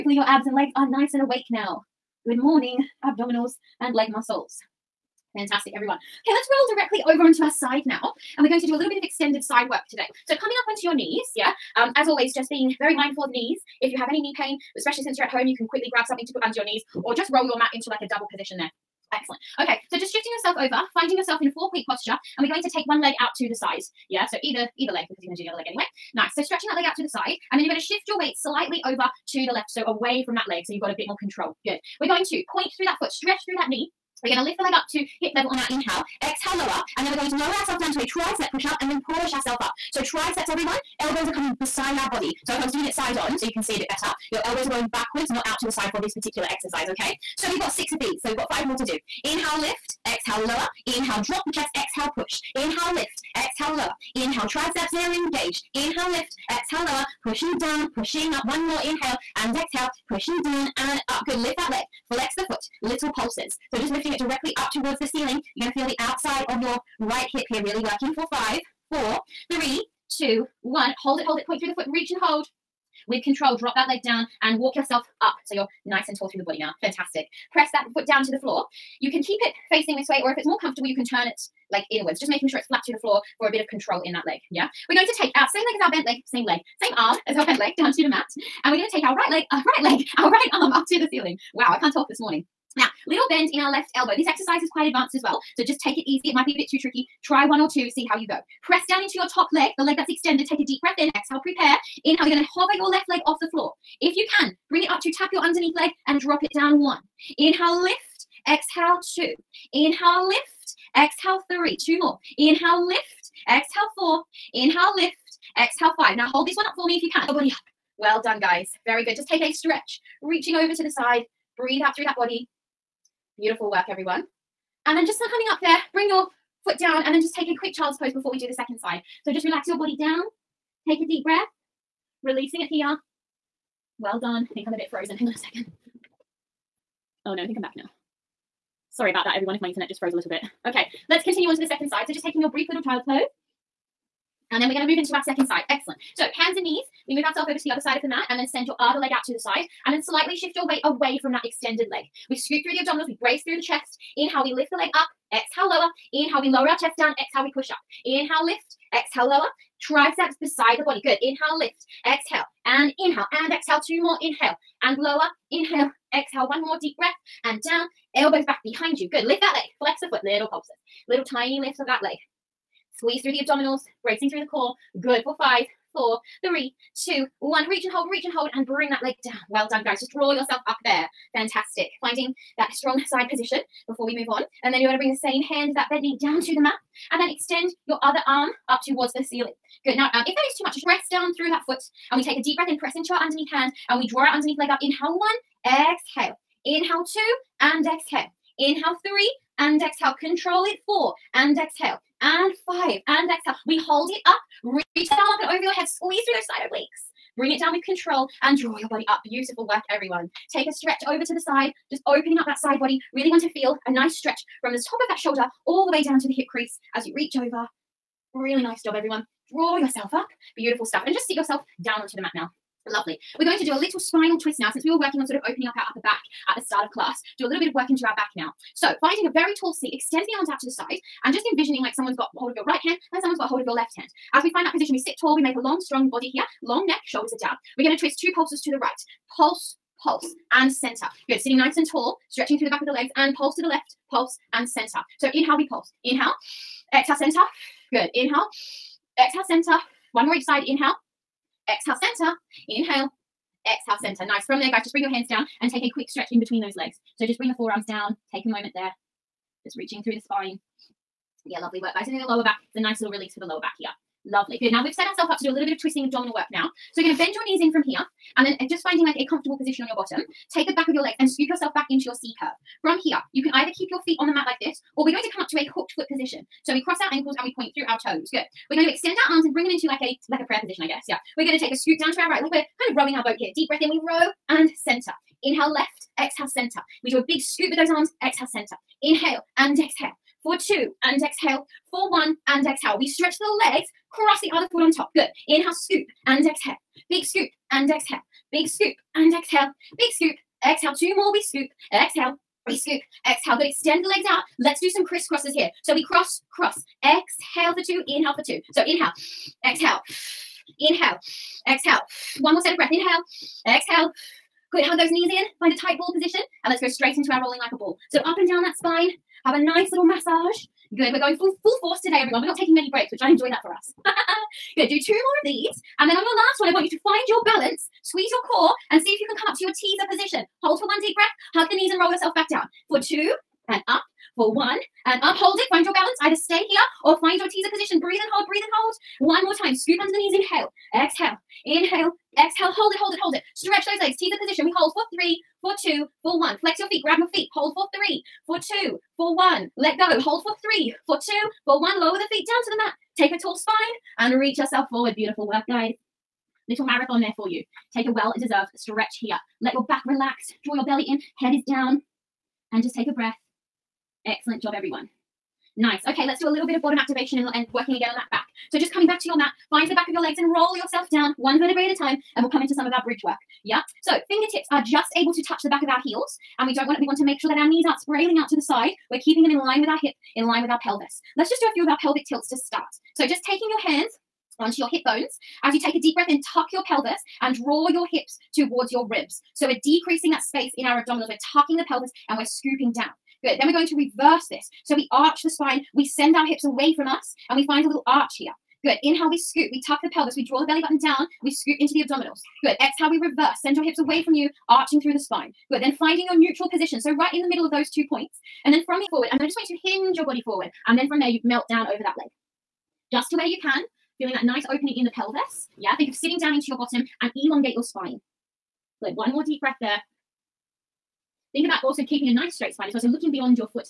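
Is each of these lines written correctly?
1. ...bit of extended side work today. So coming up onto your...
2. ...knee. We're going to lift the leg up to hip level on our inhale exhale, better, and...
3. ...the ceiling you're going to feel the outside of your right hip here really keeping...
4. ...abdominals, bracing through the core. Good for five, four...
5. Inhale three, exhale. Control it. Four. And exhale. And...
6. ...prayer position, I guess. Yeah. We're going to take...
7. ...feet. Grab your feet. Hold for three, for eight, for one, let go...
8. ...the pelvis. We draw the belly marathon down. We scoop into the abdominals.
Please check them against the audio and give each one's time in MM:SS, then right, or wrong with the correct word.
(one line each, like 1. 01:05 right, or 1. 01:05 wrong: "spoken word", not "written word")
1. 00:08 right
2. 00:33 wrong: "lower", not "better"
3. 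01:04 wrong: "working", not "keeping"
4. 02:53 right
5. 03:18 right
6. 04:40 right
7. 05:46 wrong: "two", not "eight"
8. 06:40 wrong: "button", not "marathon".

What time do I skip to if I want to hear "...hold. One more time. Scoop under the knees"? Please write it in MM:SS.
05:38.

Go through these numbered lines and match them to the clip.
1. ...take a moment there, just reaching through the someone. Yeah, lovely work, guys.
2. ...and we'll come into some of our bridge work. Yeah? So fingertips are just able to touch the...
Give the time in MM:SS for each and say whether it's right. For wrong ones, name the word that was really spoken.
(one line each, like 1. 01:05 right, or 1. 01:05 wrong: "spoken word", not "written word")
1. 04:18 wrong: "spine", not "someone"
2. 06:12 right.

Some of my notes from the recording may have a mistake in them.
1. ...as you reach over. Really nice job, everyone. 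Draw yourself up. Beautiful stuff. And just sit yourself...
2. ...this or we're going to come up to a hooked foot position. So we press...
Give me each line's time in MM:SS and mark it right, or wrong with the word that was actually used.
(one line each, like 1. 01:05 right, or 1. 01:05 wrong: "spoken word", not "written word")
1. 03:36 right
2. 04:34 wrong: "cross", not "press".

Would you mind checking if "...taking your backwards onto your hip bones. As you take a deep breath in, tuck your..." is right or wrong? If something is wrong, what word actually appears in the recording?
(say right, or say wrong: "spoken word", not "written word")
wrong: "hands", not "backwards".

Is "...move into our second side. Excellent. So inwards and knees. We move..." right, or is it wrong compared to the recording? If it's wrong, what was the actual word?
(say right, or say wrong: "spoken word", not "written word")
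wrong: "hands", not "inwards".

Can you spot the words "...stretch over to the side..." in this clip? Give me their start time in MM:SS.
03:30.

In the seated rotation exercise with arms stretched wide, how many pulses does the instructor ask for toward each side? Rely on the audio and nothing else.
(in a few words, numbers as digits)
2.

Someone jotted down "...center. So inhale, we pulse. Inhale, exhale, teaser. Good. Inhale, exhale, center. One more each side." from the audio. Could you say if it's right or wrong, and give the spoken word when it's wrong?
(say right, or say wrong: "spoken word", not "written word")
wrong: "center", not "teaser".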